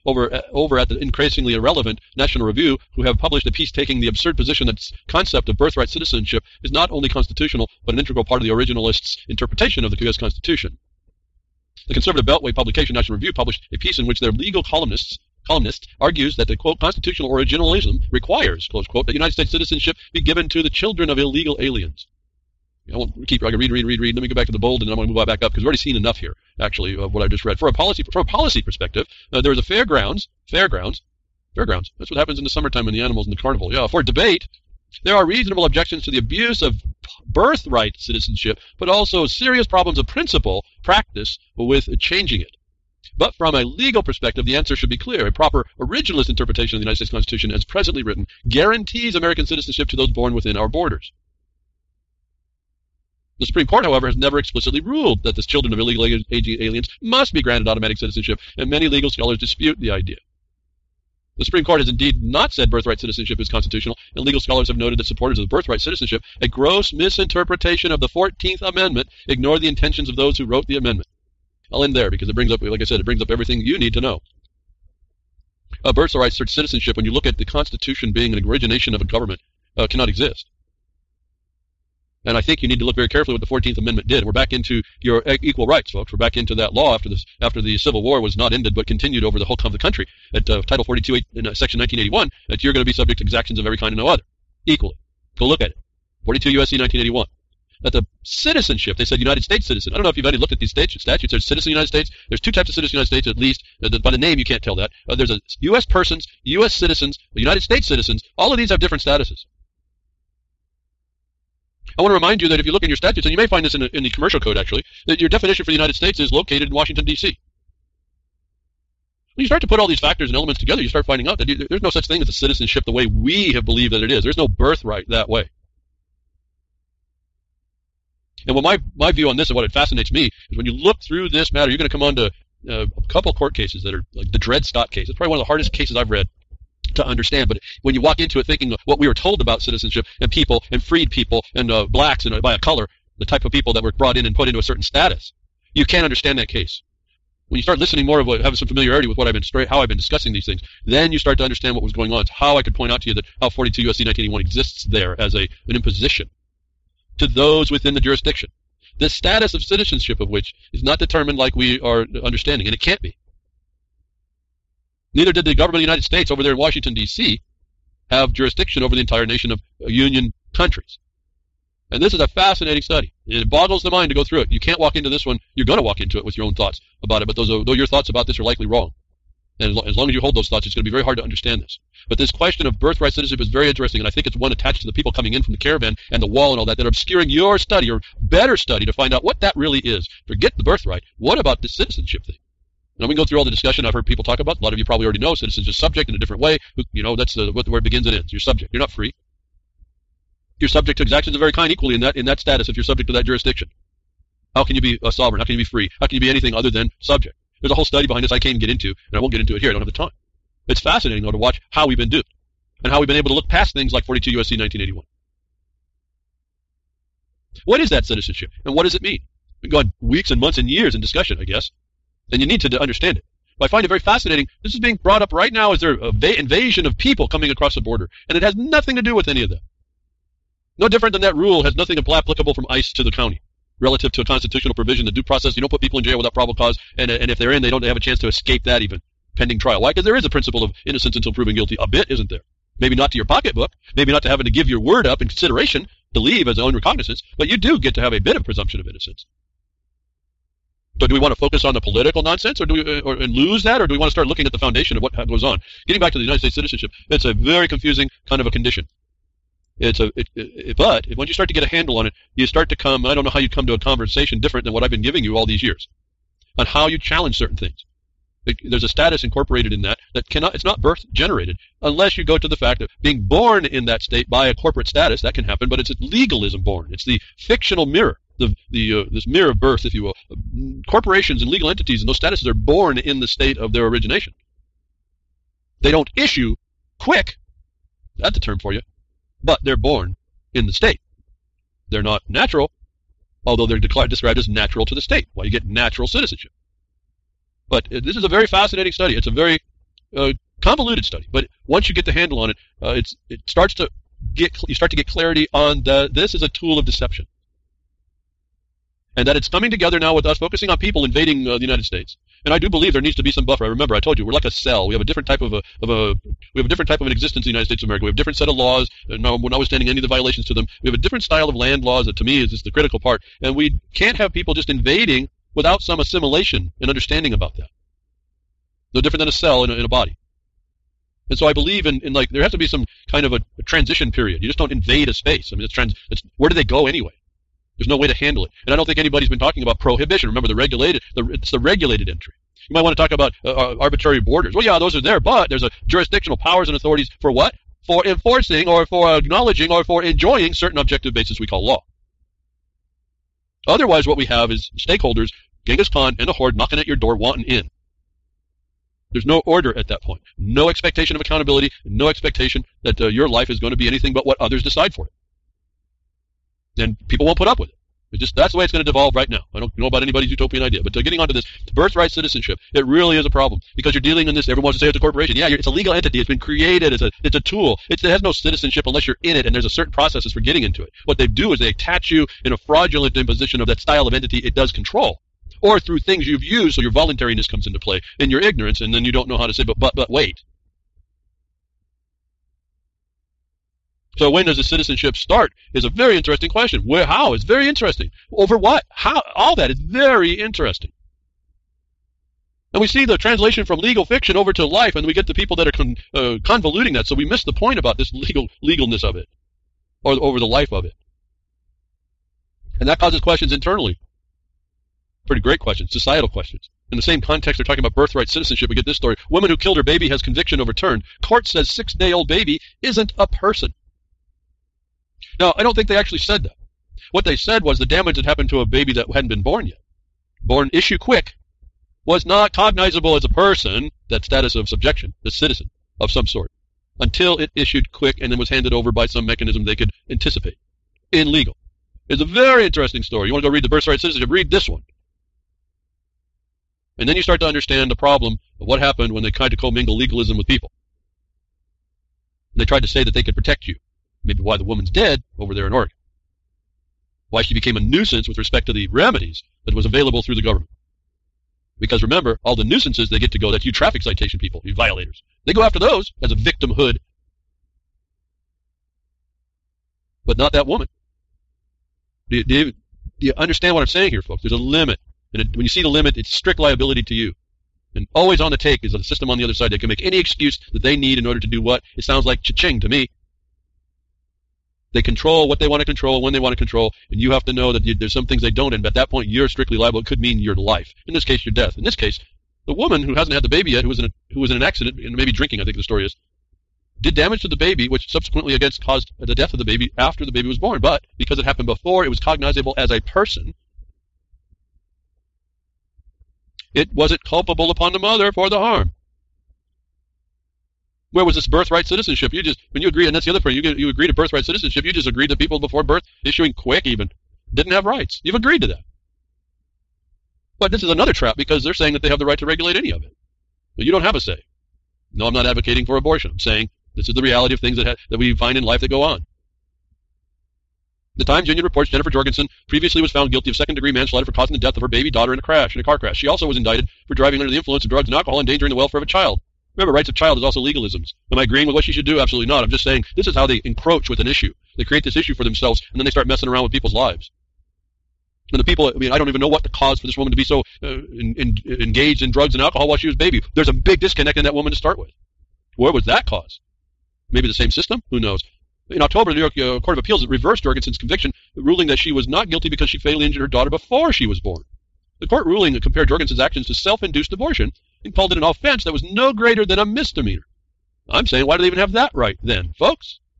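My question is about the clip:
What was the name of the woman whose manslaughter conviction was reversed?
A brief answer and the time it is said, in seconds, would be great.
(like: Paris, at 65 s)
Jennifer Jorgensen, at 531 s.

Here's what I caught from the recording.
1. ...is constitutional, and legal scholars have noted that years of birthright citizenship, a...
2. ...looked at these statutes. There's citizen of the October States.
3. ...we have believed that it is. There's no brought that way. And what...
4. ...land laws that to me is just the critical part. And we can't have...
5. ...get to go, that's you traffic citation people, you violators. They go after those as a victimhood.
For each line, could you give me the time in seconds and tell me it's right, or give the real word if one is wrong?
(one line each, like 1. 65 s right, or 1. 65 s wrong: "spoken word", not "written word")
1. 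63 s wrong: "supporters", not "years"
2. 100 s wrong: "United", not "October"
3. 123 s wrong: "birthright", not "brought"
4. 321 s right
5. 463 s right.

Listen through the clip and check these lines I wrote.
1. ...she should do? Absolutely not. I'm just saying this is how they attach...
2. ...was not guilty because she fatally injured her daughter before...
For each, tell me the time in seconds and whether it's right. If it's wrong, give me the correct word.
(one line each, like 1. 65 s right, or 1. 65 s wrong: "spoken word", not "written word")
1. 541 s wrong: "encroach", not "attach"
2. 562 s right.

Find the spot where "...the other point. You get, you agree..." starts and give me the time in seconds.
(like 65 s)
513 s.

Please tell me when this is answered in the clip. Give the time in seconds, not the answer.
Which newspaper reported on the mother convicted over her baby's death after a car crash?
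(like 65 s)
531 s.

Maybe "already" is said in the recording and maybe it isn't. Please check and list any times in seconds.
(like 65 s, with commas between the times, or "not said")
25 s, 195 s.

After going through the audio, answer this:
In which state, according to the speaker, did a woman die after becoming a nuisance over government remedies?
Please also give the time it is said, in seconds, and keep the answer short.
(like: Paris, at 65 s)
Oregon, at 455 s.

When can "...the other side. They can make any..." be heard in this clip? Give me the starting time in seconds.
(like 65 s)
479 s.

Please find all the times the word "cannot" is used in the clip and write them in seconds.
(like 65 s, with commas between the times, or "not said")
79 s, 270 s.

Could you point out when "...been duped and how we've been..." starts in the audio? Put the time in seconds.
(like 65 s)
211 s.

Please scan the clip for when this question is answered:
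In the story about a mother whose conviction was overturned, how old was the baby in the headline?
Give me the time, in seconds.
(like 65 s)
421 s.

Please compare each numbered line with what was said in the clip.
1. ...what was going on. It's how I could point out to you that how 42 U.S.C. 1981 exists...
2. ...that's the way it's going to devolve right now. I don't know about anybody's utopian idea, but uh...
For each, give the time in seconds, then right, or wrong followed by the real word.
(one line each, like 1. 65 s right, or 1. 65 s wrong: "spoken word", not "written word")
1. 151 s right
2. 368 s right.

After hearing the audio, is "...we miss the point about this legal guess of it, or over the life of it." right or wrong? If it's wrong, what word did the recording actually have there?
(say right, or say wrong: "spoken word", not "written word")
wrong: "legalness", not "guess".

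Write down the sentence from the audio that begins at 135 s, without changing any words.
It's probably one of the hardest cases I've read to understand.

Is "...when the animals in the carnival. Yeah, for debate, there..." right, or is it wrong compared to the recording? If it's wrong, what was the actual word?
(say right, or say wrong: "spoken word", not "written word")
right.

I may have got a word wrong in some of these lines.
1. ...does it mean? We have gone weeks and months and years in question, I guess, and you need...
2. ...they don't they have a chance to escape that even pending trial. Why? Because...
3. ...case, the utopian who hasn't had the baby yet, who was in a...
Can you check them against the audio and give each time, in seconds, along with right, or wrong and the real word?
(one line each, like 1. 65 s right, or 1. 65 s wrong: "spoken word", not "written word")
1. 218 s wrong: "discussion", not "question"
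2. 237 s right
3. 491 s wrong: "woman", not "utopian".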